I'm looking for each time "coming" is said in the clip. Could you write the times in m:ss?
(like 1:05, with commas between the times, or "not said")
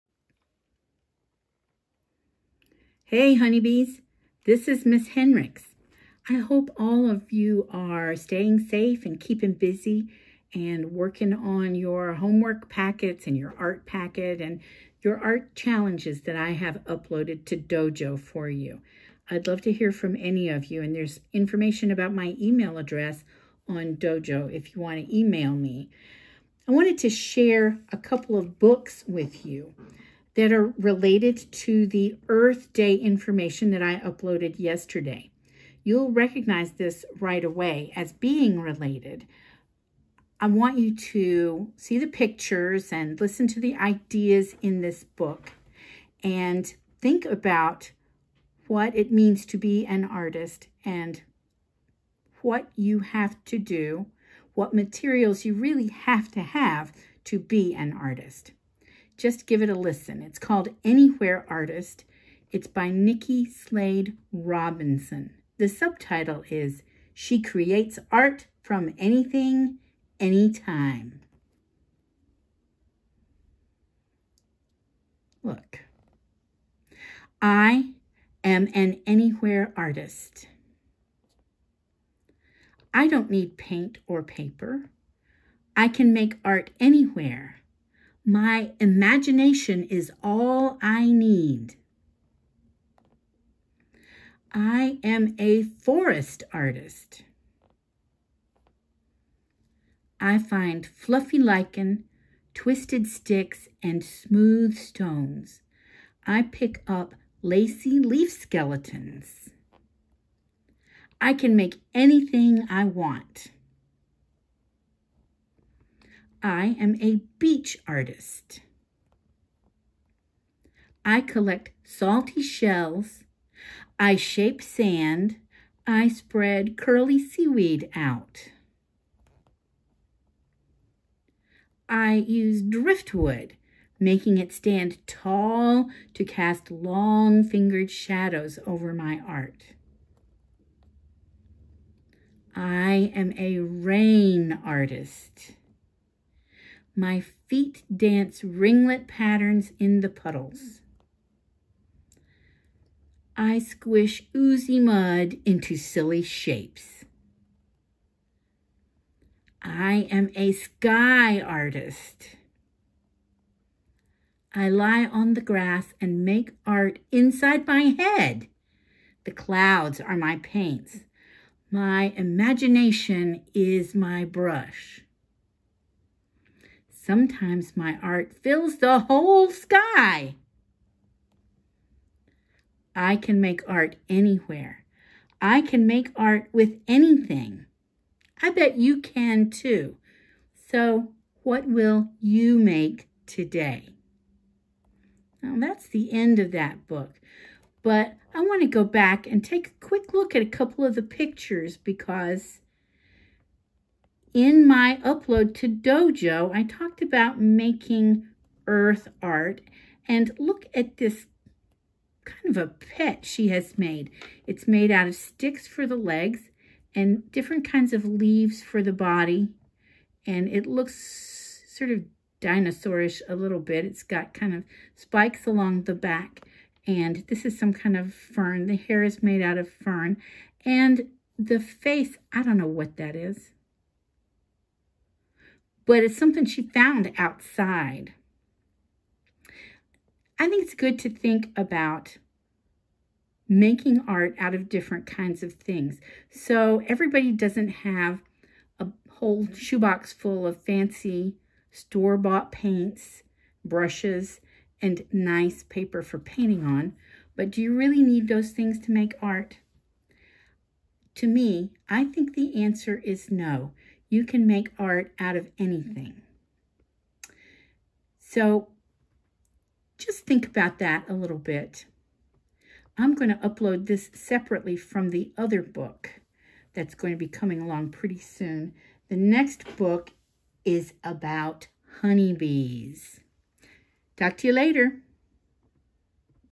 4:37.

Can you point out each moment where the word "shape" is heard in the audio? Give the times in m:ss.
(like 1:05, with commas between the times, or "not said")
2:04, 2:36.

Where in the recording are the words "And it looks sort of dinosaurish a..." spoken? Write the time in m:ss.
3:40.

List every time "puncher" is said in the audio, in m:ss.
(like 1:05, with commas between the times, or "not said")
not said.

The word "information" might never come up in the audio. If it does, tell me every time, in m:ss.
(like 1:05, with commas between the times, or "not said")
0:21, 0:32.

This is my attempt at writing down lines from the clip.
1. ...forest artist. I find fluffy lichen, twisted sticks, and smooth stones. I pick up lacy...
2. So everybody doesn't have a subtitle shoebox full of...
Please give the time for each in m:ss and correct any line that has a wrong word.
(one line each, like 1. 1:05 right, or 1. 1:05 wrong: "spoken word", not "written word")
1. 1:35 right
2. 4:06 wrong: "whole", not "subtitle".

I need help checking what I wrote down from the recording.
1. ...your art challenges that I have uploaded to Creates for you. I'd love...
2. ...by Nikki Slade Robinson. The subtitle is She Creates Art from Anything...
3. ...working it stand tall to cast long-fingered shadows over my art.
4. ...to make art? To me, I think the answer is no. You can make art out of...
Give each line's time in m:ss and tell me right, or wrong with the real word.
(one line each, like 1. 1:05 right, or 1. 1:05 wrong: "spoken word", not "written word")
1. 0:15 wrong: "Dojo", not "Creates"
2. 1:02 right
3. 2:13 wrong: "making", not "working"
4. 4:18 right.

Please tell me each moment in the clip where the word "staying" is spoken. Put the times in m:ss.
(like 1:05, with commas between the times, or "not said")
0:08.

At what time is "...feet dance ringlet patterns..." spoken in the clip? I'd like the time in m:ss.
2:27.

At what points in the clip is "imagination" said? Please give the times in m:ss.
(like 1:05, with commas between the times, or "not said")
1:28, 2:52.